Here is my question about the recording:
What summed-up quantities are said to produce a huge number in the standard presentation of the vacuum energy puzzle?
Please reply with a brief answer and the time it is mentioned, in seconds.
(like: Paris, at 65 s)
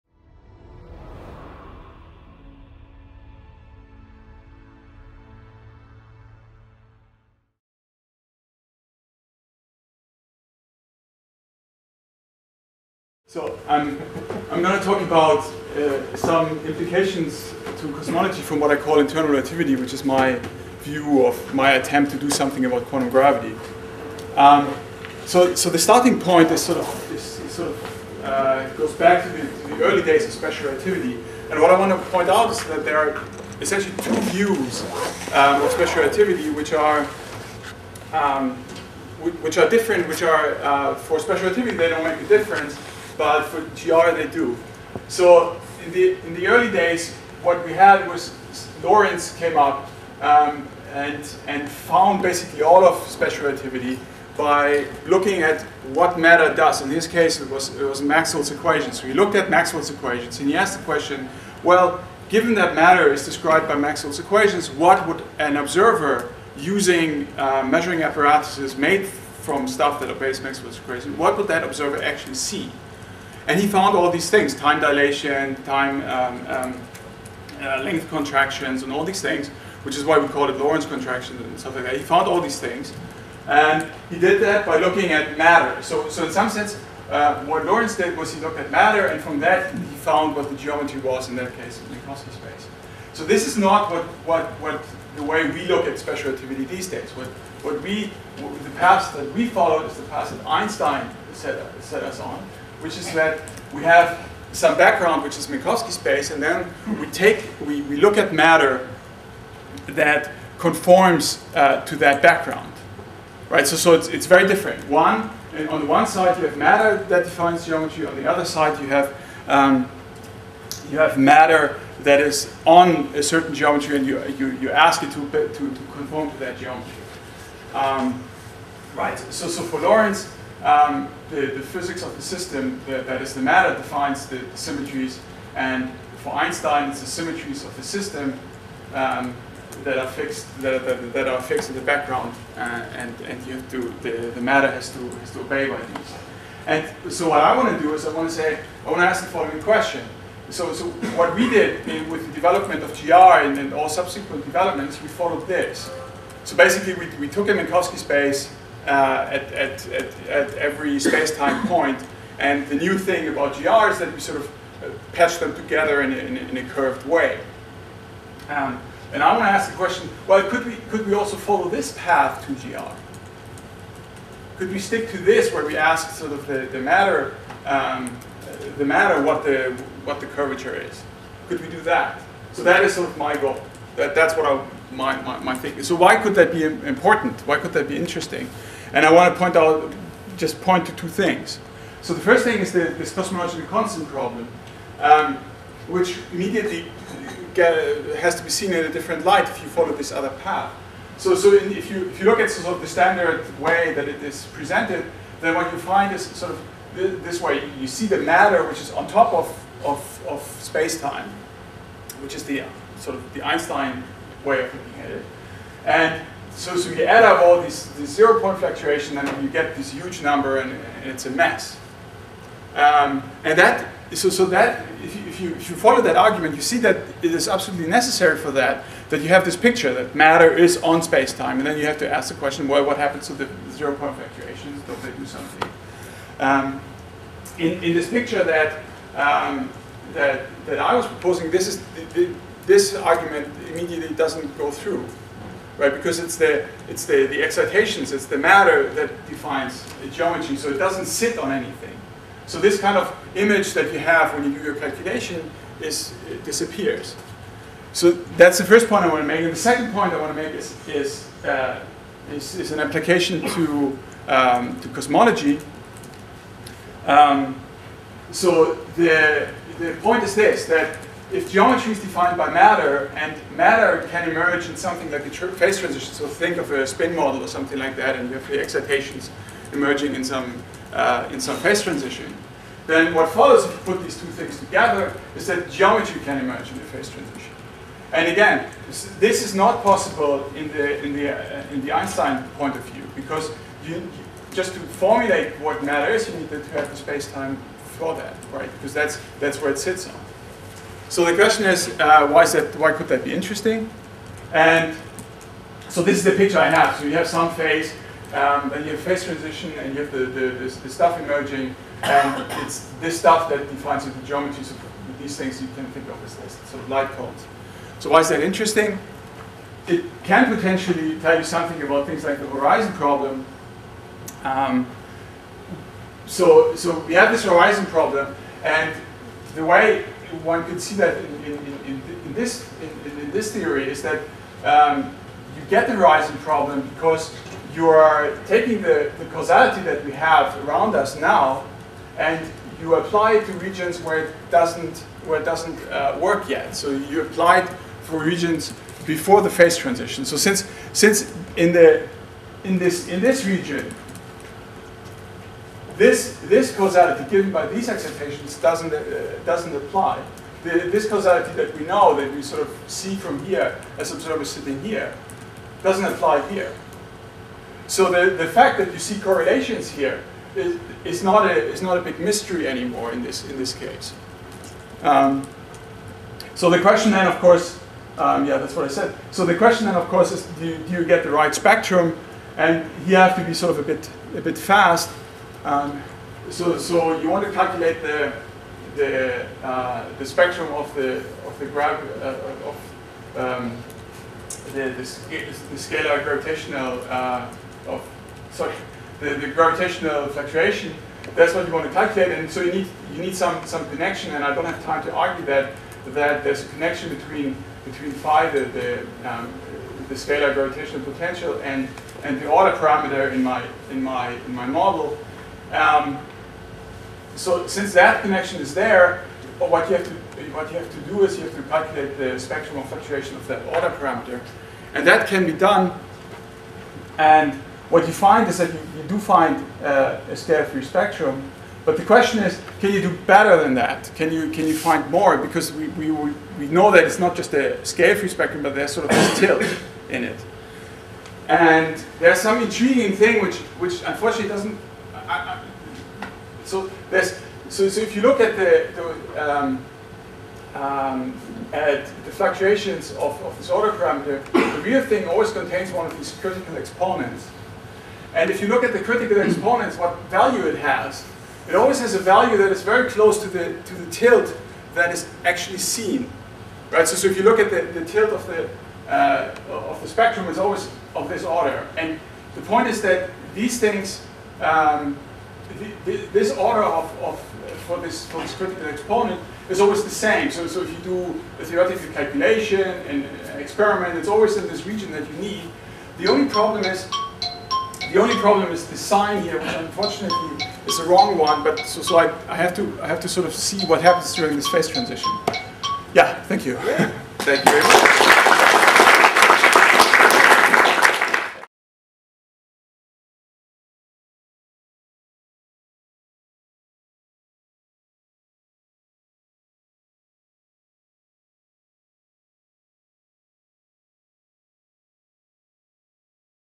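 zero point fluctuations, at 218 s.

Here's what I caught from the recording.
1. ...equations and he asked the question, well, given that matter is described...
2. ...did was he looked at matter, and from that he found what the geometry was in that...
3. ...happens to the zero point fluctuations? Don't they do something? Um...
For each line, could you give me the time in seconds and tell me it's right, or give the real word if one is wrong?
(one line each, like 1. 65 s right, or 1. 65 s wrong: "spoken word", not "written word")
1. 59 s right
2. 87 s right
3. 232 s right.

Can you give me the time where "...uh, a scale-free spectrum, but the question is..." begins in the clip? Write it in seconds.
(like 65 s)
429 s.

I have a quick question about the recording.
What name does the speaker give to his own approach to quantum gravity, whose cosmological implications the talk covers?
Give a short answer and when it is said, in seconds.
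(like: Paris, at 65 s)
internal relativity, at 18 s.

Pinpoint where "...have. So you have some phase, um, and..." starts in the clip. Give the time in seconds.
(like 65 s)
306 s.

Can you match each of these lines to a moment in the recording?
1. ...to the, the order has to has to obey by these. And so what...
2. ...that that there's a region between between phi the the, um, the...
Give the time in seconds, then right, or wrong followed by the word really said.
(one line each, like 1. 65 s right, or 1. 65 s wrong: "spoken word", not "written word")
1. 143 s wrong: "matter", not "order"
2. 405 s wrong: "connection", not "region".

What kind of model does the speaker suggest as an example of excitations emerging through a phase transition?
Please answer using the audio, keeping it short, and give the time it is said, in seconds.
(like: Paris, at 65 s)
a spin model, at 276 s.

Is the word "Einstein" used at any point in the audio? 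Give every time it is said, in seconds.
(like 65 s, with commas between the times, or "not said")
100 s, 136 s, 213 s, 291 s.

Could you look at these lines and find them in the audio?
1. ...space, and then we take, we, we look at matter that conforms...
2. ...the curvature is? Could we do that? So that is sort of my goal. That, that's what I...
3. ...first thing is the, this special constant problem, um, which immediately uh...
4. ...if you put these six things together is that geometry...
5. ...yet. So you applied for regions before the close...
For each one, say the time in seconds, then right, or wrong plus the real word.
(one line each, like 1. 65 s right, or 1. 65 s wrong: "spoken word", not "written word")
1. 105 s right
2. 180 s right
3. 192 s wrong: "cosmological", not "special"
4. 283 s wrong: "two", not "six"
5. 346 s wrong: "phase", not "close".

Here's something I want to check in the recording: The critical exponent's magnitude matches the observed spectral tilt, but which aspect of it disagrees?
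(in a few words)
the sign.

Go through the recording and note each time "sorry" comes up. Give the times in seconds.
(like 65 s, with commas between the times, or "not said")
398 s.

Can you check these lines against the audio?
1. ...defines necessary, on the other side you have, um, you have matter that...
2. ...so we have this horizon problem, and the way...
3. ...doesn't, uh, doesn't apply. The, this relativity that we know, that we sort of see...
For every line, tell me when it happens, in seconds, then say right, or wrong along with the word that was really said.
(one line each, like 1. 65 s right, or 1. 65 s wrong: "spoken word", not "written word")
1. 117 s wrong: "geometry", not "necessary"
2. 326 s right
3. 358 s wrong: "causality", not "relativity".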